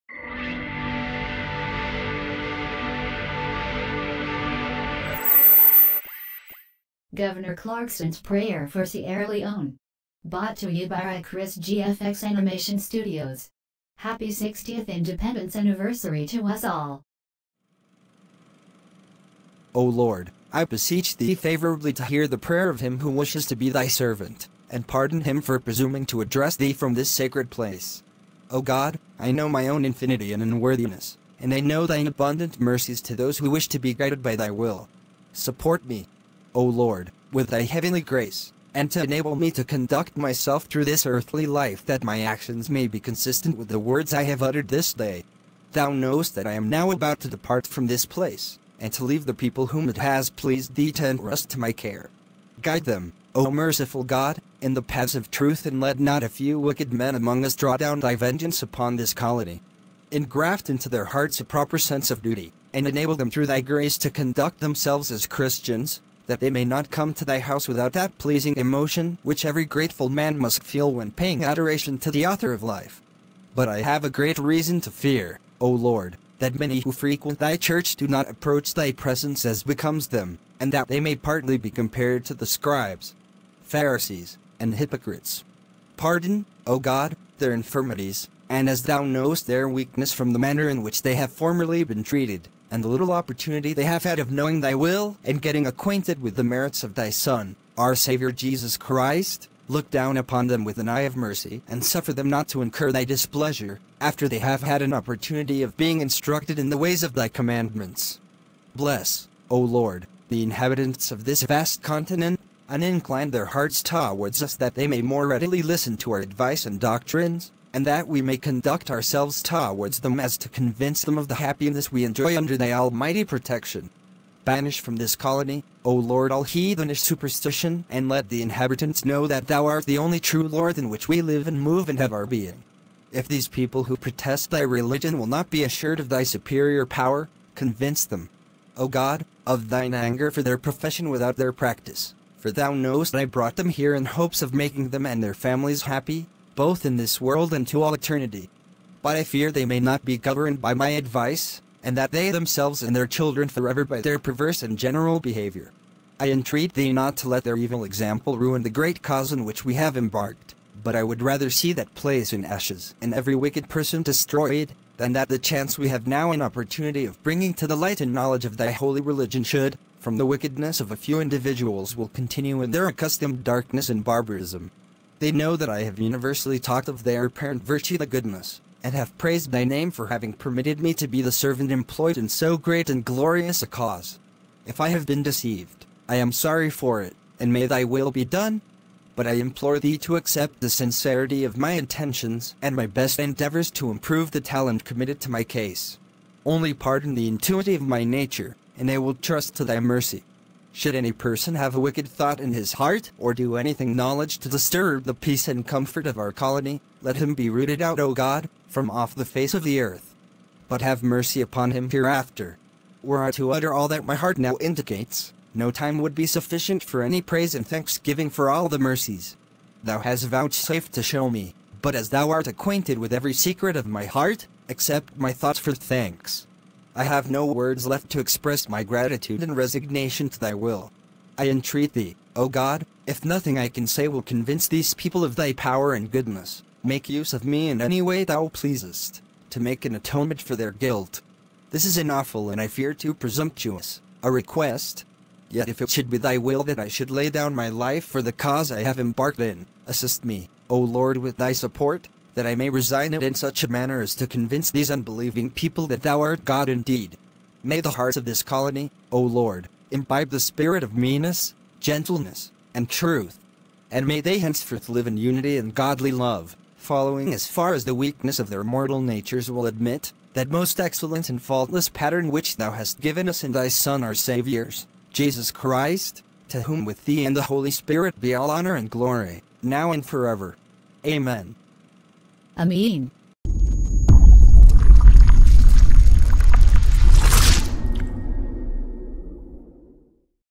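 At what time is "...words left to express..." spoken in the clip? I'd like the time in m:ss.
3:47.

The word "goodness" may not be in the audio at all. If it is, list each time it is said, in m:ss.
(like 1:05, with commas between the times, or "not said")
2:58, 3:56.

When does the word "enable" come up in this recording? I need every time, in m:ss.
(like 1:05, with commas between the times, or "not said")
0:39, 1:02.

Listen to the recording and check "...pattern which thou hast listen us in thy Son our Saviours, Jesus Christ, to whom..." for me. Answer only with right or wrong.
wrong.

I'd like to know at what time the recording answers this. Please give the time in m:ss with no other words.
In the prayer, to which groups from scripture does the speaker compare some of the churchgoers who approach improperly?
1:22.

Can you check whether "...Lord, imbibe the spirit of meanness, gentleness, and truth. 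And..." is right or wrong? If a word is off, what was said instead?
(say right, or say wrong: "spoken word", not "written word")
right.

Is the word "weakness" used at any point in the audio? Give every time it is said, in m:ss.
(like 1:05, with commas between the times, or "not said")
1:29, 4:27.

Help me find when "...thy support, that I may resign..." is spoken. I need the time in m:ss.
4:11.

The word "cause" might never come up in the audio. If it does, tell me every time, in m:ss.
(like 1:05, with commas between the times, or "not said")
2:39, 3:03, 4:08.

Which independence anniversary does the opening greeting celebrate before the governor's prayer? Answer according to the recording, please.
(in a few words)
60th.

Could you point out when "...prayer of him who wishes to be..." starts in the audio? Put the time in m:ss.
0:22.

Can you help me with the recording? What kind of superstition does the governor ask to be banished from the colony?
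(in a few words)
heathenish superstition.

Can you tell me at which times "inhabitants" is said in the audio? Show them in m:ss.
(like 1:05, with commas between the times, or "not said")
1:50, 2:08.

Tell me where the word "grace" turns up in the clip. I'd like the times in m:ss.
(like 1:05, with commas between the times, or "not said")
0:38, 1:03.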